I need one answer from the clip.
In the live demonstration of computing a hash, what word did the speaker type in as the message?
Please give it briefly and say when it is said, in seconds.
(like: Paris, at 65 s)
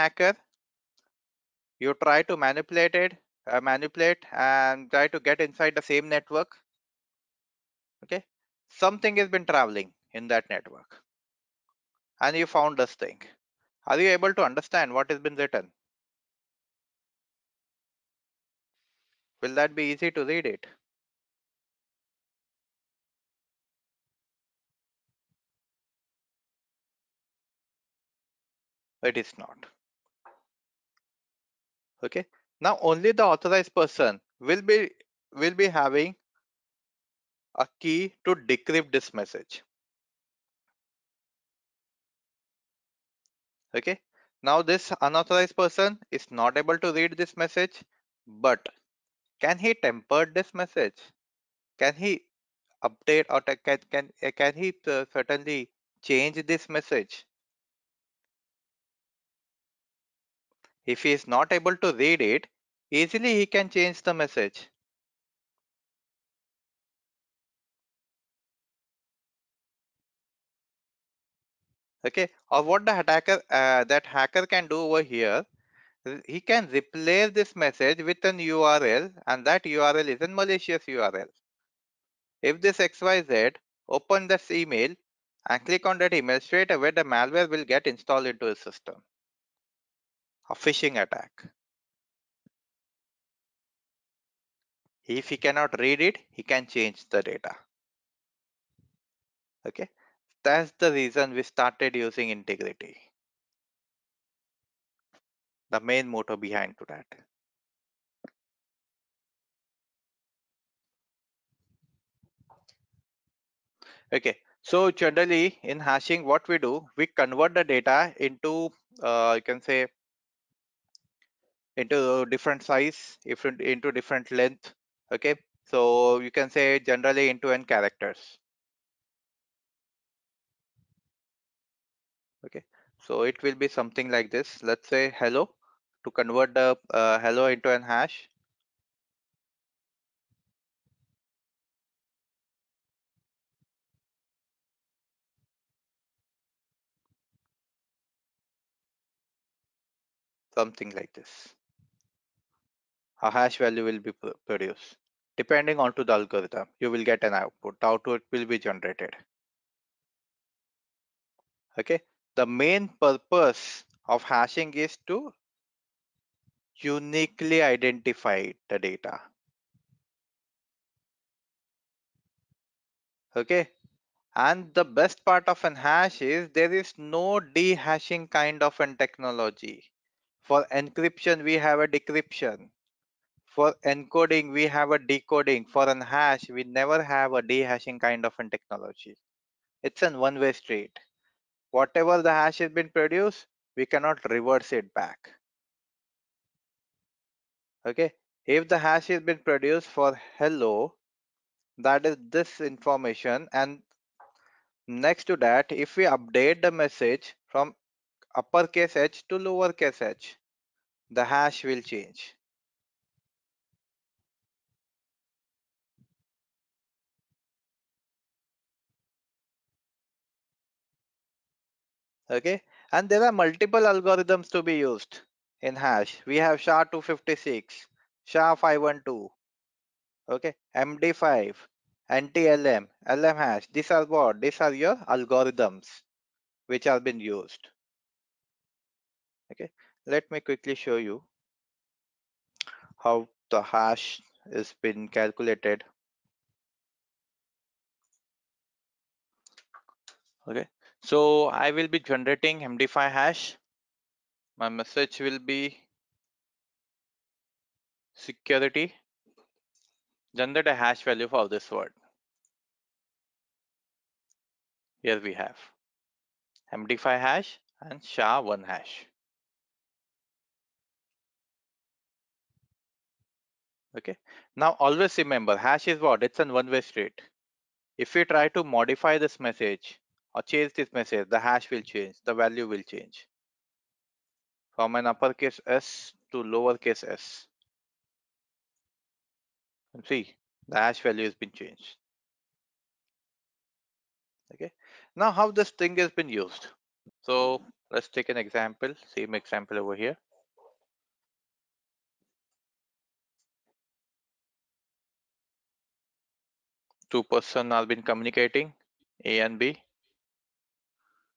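security, at 258 s.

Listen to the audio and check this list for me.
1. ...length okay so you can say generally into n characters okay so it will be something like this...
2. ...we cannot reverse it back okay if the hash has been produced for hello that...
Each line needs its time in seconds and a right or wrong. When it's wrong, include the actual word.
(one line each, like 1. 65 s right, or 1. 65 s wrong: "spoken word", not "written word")
1. 124 s right
2. 193 s right.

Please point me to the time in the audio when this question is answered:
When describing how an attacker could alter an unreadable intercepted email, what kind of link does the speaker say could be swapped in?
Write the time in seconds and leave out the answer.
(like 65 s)
80 s.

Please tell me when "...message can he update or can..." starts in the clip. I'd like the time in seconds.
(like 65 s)
50 s.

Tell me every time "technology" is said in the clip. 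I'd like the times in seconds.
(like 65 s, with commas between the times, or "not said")
178 s, 188 s.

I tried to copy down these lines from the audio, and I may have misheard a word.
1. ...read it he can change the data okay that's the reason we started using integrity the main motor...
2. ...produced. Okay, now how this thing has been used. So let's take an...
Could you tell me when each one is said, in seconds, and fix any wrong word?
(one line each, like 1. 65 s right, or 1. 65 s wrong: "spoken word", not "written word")
1. 95 s right
2. 291 s wrong: "changed", not "produced".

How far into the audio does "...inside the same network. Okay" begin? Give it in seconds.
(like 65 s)
5 s.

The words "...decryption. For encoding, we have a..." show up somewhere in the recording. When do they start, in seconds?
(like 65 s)
181 s.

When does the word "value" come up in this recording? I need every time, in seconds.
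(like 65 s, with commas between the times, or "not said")
153 s, 261 s, 282 s, 291 s.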